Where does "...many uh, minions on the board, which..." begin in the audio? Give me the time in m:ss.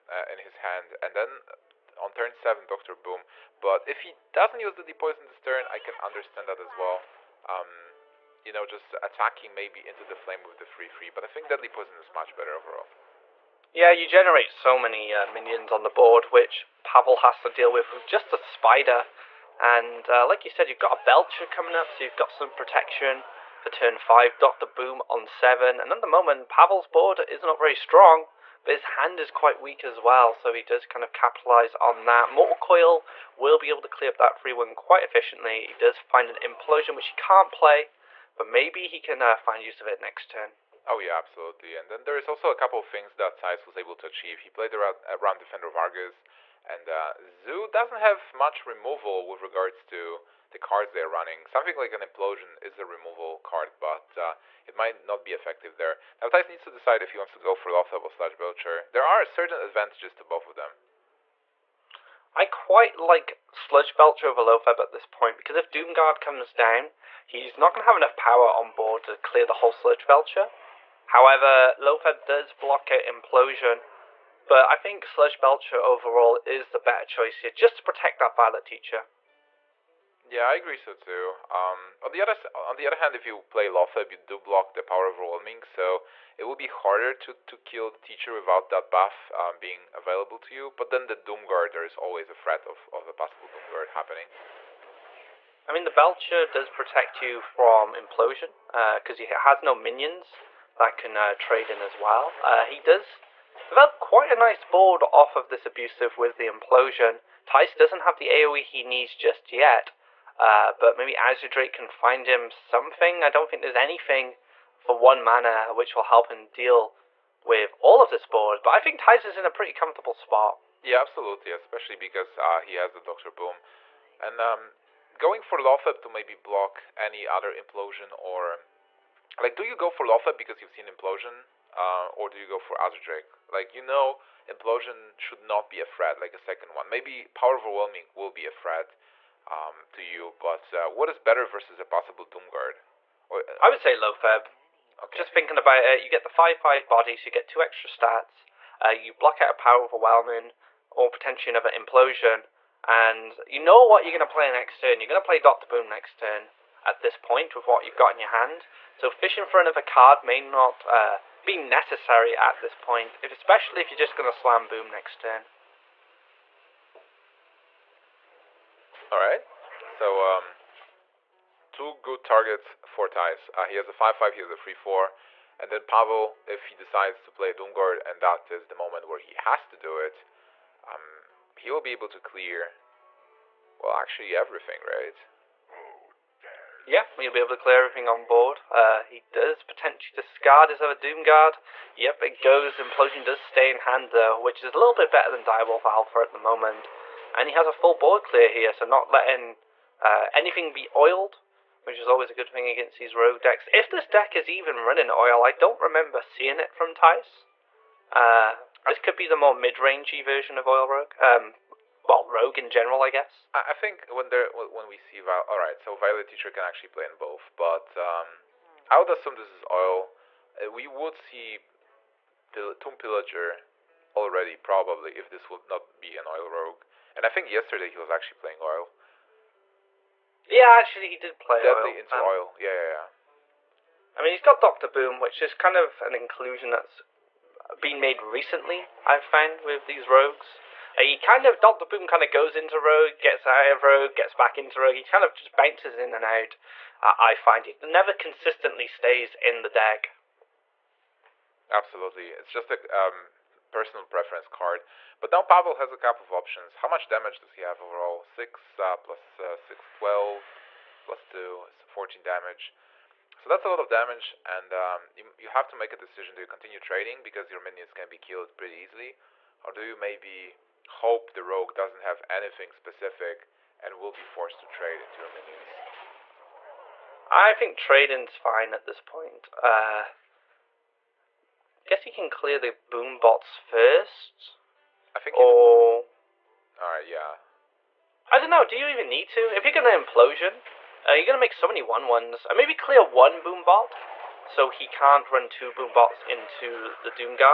0:14.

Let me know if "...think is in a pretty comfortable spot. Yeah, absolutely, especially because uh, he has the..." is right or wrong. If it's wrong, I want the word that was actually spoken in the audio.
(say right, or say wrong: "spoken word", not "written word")
right.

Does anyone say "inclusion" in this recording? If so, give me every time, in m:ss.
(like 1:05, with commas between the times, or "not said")
3:56.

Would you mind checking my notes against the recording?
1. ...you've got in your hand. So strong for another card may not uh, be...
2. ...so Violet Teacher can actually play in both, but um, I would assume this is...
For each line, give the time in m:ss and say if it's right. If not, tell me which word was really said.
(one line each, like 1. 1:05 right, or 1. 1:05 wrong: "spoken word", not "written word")
1. 2:37 wrong: "fishing", not "strong"
2. 3:35 right.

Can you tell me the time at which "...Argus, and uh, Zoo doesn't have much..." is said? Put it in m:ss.
0:45.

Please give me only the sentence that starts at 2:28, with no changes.
Uh, you block out a power overwhelming or potentially another implosion.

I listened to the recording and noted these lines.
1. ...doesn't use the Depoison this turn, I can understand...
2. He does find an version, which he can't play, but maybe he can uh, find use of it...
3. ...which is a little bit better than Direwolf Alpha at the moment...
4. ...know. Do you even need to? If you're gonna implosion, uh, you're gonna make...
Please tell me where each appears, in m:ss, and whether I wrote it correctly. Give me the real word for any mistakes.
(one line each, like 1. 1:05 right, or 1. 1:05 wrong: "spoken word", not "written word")
1. 0:04 right
2. 0:35 wrong: "implosion", not "version"
3. 3:14 right
4. 4:48 right.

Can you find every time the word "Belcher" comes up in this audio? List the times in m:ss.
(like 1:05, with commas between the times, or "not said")
0:21, 0:58, 1:03, 1:10, 1:15, 1:35.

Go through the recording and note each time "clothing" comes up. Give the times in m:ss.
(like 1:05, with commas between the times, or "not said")
not said.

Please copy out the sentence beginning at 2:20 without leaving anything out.
But uh, what is better versus a possible Doomguard?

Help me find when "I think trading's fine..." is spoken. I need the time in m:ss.
4:37.